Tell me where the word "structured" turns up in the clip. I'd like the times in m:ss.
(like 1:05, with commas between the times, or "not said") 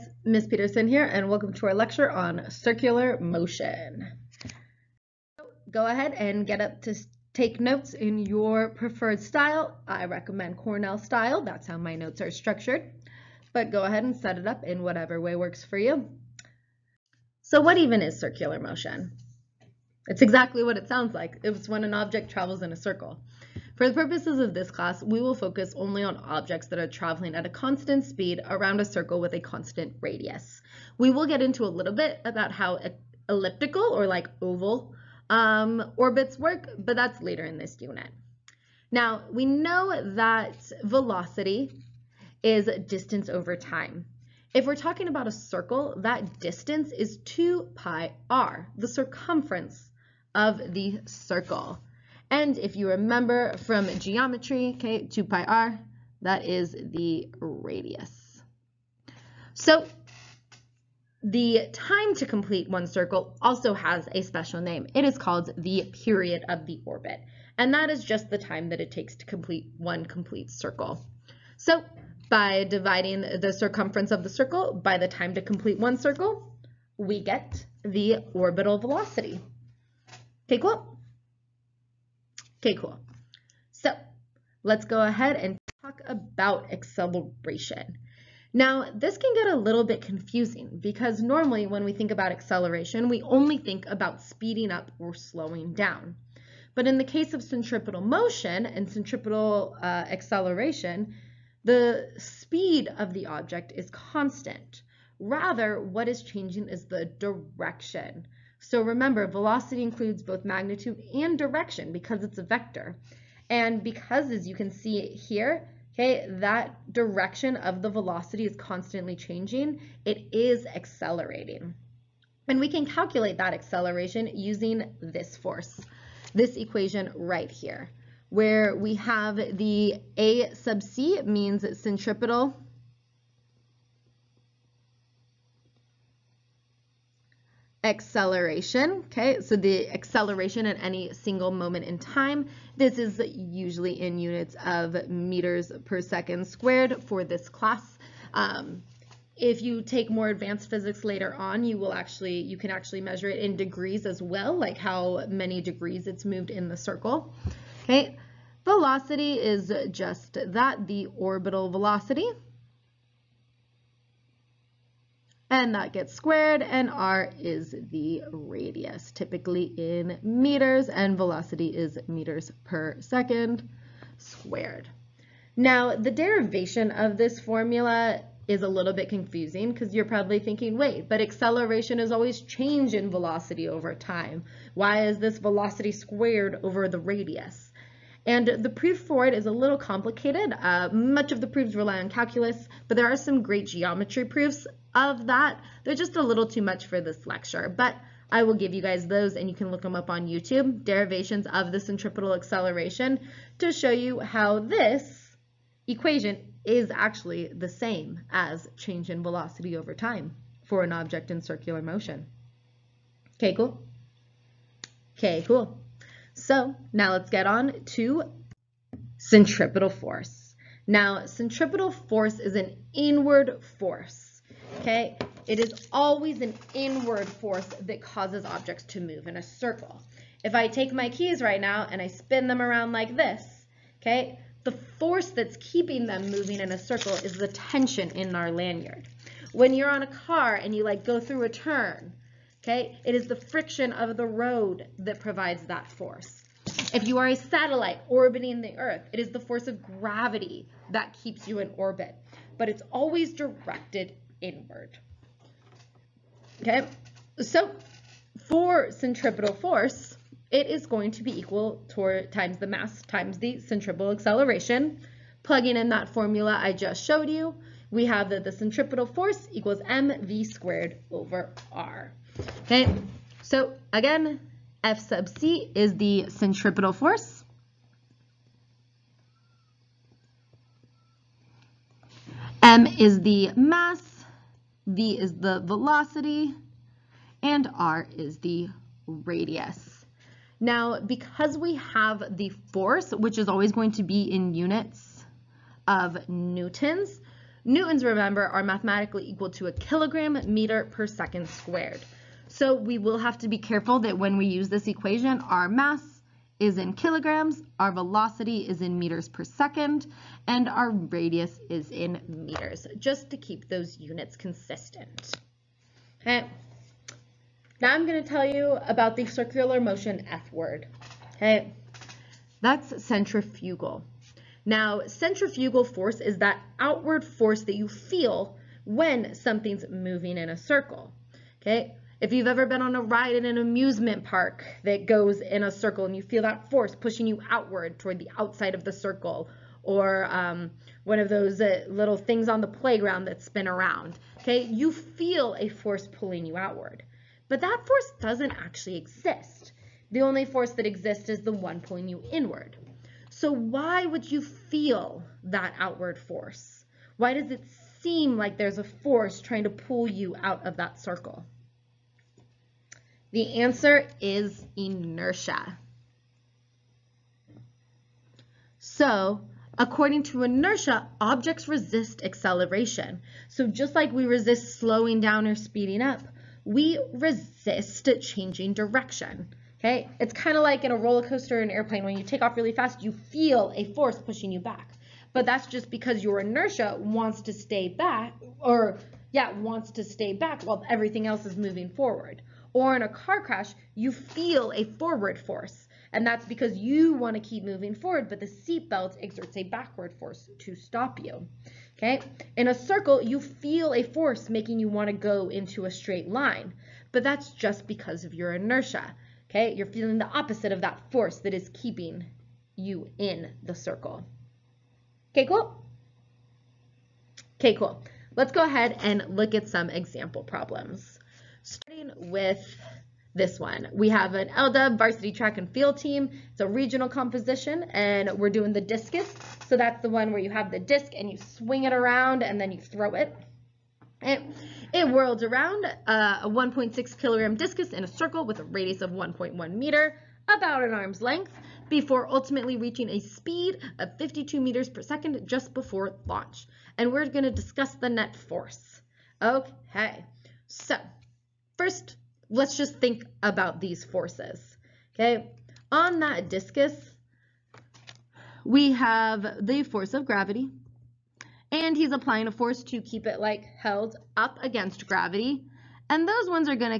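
0:12.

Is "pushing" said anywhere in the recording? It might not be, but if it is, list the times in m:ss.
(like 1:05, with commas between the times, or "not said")
5:36, 6:24.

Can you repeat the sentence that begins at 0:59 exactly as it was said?
So the time to complete one circle also has a special name.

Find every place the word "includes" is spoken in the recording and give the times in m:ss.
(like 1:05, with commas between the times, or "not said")
1:49.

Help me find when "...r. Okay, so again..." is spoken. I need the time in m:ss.
4:31.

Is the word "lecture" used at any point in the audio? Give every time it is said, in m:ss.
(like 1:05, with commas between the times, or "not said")
0:01, 3:17.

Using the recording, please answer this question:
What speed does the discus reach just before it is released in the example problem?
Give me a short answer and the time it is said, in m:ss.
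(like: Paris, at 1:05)
52 meters per second, at 7:24.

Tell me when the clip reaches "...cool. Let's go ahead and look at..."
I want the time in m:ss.
6:57.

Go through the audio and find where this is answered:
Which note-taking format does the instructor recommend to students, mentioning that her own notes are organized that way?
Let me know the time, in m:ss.
0:10.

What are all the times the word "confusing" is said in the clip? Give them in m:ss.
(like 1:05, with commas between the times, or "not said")
1:30, 2:59.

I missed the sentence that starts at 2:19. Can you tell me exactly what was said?
So the acceleration at any single moment in time, this is usually in units of meters per second squared for this class.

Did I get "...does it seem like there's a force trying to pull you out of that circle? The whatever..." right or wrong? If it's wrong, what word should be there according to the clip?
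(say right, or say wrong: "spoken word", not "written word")
wrong: "answer", not "whatever".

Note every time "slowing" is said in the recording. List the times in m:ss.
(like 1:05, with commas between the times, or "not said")
1:35, 6:14.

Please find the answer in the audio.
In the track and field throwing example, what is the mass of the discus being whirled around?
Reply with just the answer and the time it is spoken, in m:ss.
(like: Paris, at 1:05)
1.6 kilograms, at 7:16.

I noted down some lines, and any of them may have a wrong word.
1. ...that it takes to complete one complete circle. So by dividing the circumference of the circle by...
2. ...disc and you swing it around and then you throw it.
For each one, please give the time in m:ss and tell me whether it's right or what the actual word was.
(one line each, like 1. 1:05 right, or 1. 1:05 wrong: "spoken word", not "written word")
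1. 1:08 right
2. 7:10 right.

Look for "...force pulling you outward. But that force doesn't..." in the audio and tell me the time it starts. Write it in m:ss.
5:45.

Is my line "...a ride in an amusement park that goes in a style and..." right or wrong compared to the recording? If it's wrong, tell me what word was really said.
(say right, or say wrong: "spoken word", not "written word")
wrong: "circle", not "style".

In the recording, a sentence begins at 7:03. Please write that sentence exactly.
We have an LDUB varsity track and field team.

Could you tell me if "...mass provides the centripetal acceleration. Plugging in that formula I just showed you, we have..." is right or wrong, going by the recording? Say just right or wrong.
wrong.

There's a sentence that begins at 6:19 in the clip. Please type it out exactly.
Okay, it's kind of like in a roller coaster or an airplane.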